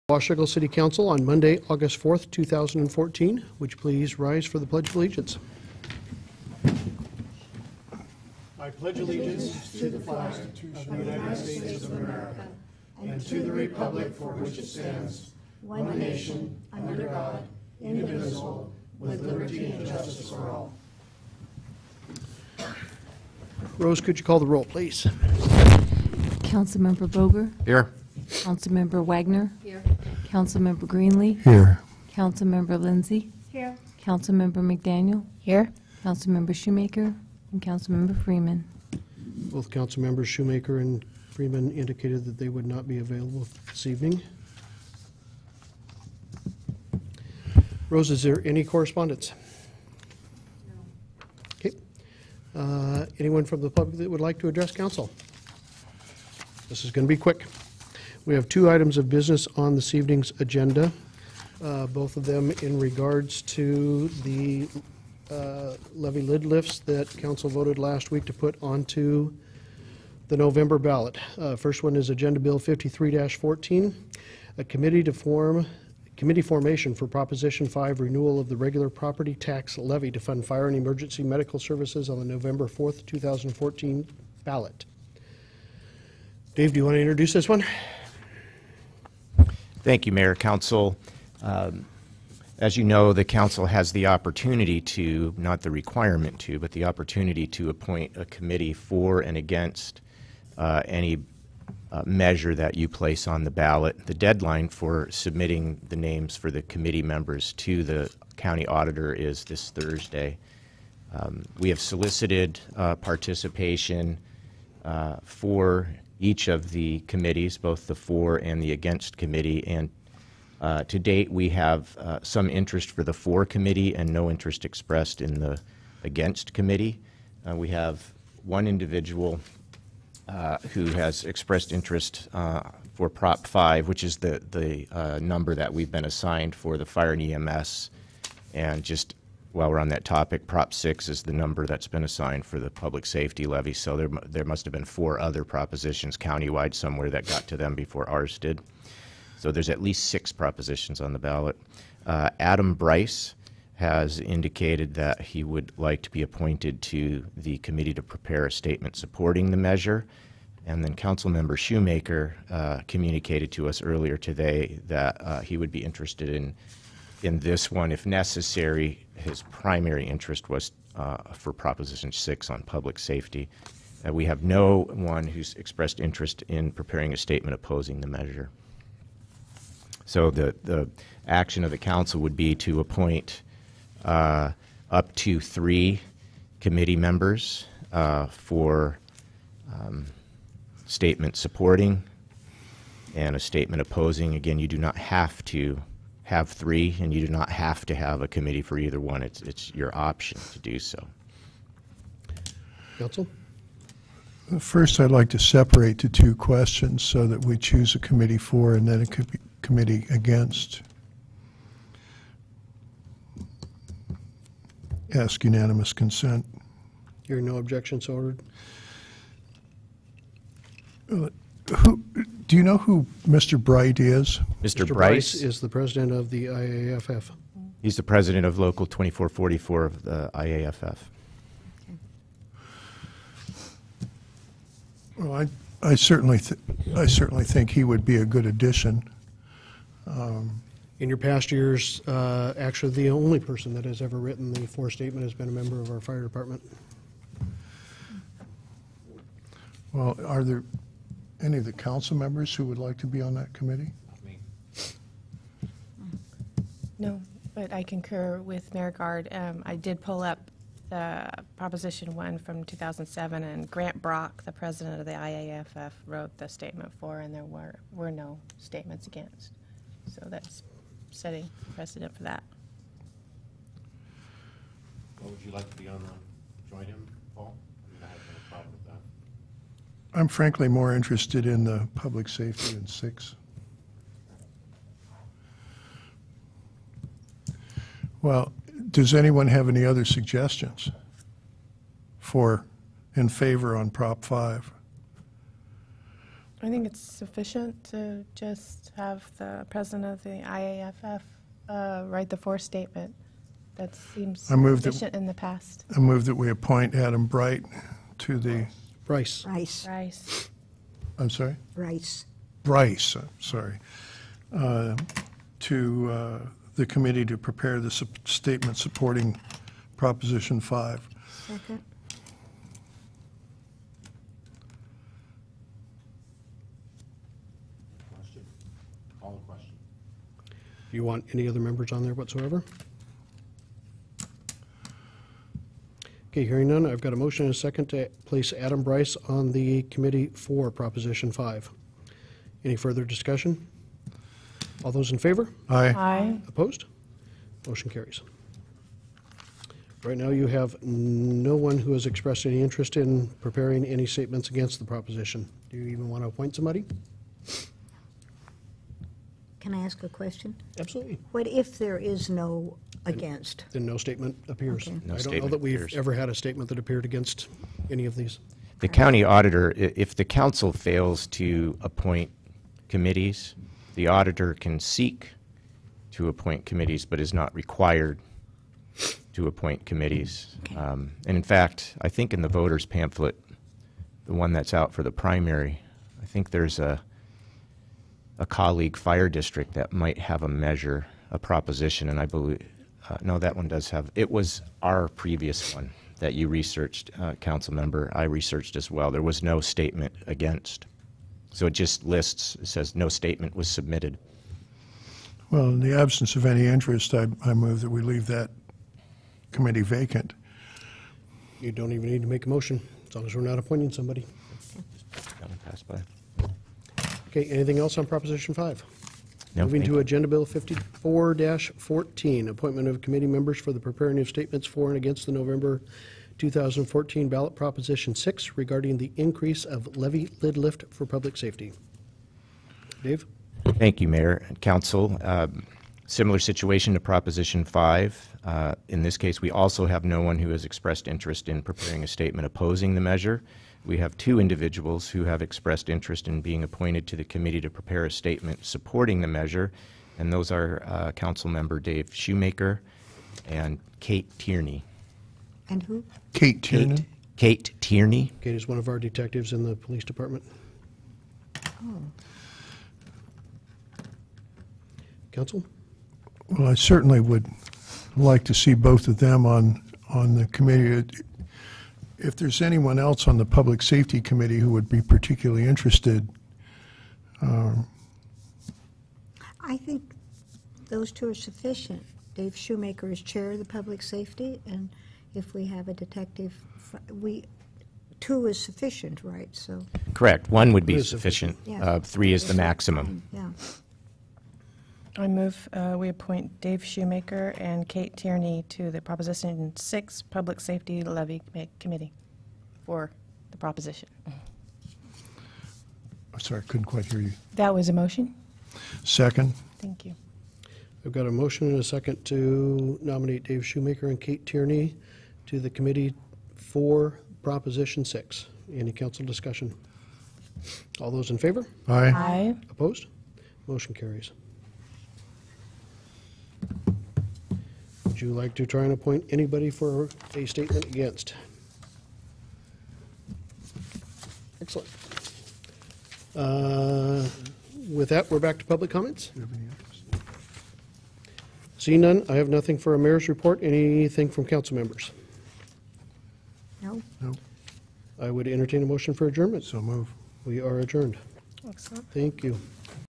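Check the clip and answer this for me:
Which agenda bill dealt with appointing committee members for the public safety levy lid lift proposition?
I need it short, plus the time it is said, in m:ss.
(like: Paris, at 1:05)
54-14, at 6:59.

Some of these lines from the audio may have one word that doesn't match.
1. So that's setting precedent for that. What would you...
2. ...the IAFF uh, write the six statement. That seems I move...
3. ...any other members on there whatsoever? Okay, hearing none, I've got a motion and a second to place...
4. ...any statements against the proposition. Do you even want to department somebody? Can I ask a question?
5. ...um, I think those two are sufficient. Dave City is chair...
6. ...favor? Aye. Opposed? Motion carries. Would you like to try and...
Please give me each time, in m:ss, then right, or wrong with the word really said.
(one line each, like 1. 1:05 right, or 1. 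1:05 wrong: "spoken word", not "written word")
1. 4:30 right
2. 5:00 wrong: "four", not "six"
3. 5:31 right
4. 5:53 wrong: "appoint", not "department"
5. 7:57 wrong: "Shoemaker", not "City"
6. 8:41 right.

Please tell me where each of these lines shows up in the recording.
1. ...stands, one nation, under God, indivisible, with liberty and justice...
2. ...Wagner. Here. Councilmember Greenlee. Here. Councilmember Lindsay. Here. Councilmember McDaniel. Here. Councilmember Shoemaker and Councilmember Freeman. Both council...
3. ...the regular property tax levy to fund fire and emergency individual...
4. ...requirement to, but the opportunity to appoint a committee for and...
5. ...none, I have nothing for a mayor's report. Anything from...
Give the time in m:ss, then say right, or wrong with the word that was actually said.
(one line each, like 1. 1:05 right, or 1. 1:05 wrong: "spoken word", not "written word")
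1. 0:14 right
2. 0:29 right
3. 1:18 wrong: "medical", not "individual"
4. 1:35 right
5. 9:02 right.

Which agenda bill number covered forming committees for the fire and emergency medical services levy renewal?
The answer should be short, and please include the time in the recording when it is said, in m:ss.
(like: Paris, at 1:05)
53-14, at 1:12.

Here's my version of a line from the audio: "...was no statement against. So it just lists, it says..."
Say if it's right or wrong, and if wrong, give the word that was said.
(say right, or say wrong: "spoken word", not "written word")
right.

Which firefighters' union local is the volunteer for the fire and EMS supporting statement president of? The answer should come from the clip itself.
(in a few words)
Local 2444.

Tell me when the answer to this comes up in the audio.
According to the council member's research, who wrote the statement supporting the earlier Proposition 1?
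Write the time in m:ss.
4:23.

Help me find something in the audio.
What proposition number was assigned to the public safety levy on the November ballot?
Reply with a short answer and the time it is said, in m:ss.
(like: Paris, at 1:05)
Prop 6, at 2:20.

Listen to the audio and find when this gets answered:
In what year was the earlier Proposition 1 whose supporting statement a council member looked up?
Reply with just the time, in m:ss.
4:22.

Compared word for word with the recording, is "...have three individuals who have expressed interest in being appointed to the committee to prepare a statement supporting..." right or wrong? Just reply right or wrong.
wrong.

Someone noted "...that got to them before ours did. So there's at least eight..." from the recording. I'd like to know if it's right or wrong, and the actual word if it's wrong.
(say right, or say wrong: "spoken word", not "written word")
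wrong: "six", not "eight".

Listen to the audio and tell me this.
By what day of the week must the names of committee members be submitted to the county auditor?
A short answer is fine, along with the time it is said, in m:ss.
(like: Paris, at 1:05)
Thursday, at 1:49.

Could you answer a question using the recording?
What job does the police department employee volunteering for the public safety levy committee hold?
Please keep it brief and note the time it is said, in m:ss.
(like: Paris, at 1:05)
Detective, at 7:38.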